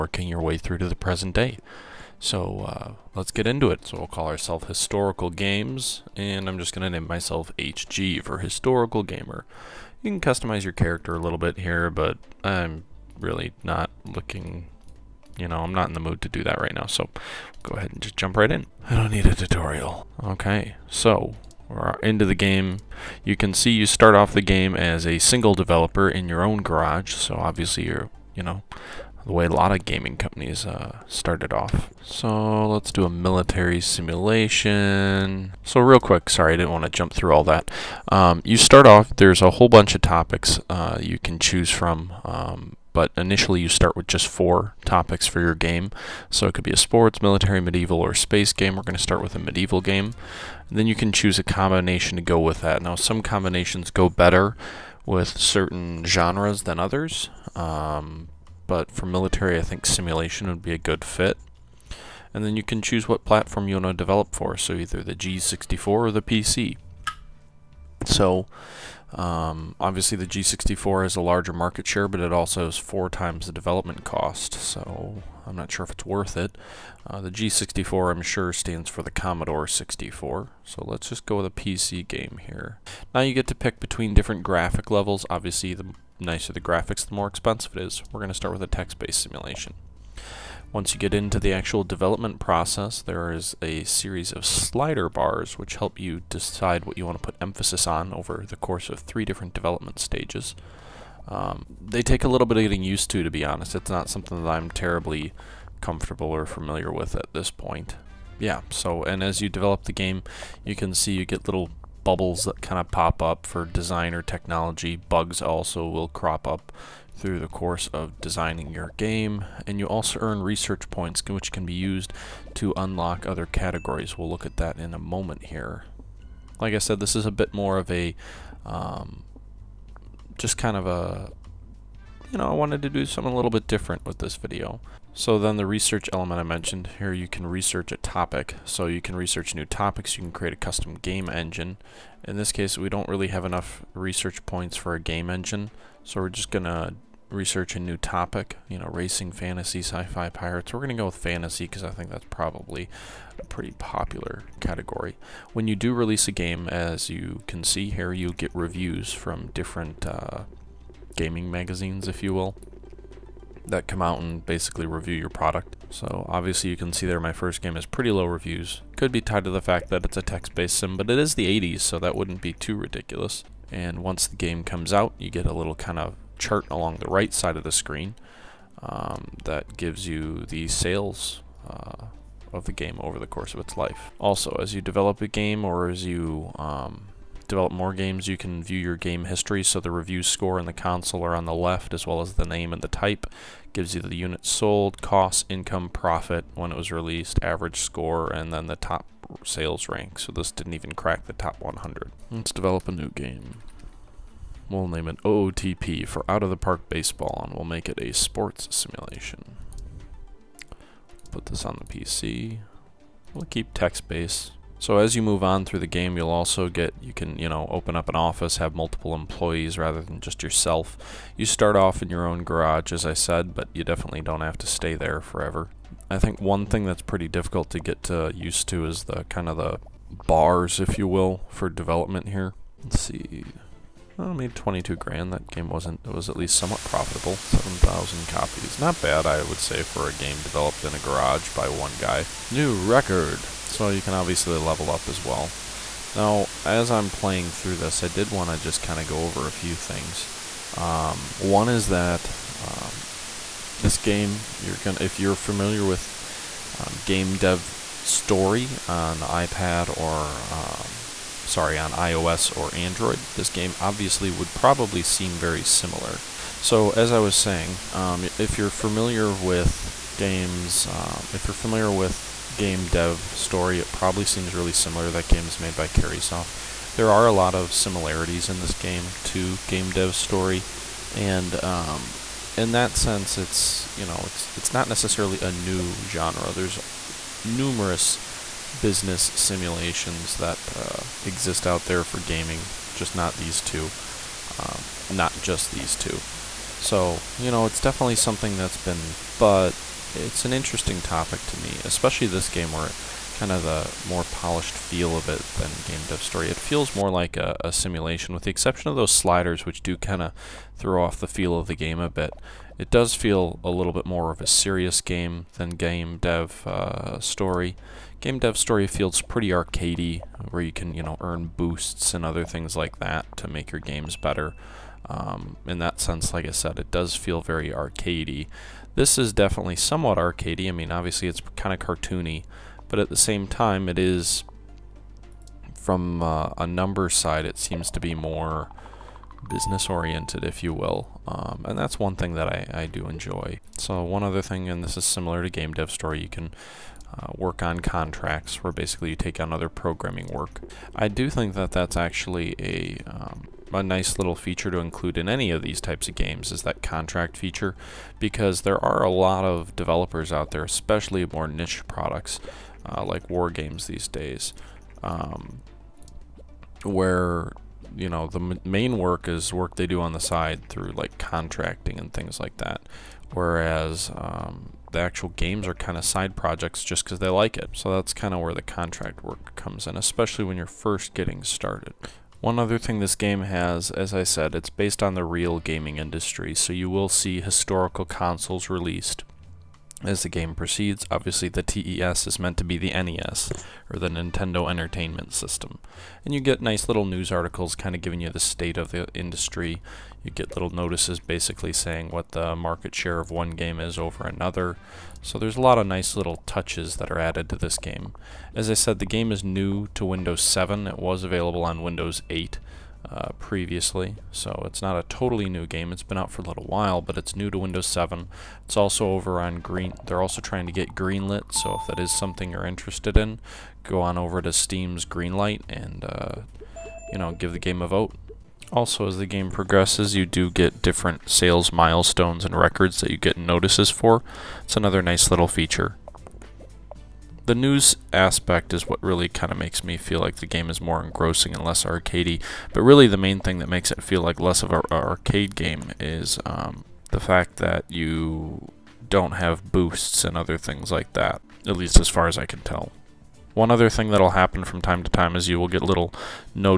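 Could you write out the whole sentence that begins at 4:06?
Now, as I'm playing through this, I did want to just kind of go over a few things.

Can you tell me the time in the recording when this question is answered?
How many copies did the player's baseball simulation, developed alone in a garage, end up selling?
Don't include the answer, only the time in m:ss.
3:57.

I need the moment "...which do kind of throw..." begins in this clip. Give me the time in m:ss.
5:09.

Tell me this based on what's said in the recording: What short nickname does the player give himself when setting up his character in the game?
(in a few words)
HG.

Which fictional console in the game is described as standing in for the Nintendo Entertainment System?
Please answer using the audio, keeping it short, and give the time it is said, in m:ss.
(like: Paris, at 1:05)
TES, at 6:31.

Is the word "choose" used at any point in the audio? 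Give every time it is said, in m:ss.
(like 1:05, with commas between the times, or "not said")
0:41, 0:51, 1:02.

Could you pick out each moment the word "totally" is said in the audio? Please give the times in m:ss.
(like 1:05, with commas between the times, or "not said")
6:55.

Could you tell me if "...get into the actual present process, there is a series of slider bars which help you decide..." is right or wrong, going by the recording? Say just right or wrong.
wrong.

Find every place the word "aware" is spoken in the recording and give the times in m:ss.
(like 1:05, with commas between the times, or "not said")
not said.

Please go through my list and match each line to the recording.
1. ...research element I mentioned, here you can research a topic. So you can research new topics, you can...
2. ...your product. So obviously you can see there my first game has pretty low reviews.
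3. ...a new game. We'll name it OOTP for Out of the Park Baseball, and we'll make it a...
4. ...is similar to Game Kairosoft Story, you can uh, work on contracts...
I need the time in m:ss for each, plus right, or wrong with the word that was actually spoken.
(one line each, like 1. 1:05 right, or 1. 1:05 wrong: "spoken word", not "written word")
1. 2:15 right
2. 2:45 right
3. 3:22 right
4. 5:44 wrong: "Dev", not "Kairosoft".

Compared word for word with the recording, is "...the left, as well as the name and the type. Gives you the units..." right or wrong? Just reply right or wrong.
right.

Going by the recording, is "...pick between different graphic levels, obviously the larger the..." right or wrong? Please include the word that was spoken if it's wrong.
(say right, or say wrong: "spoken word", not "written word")
wrong: "nicer", not "larger".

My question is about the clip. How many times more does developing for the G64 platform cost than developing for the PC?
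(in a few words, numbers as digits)
four times.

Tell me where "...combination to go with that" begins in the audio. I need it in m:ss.
0:51.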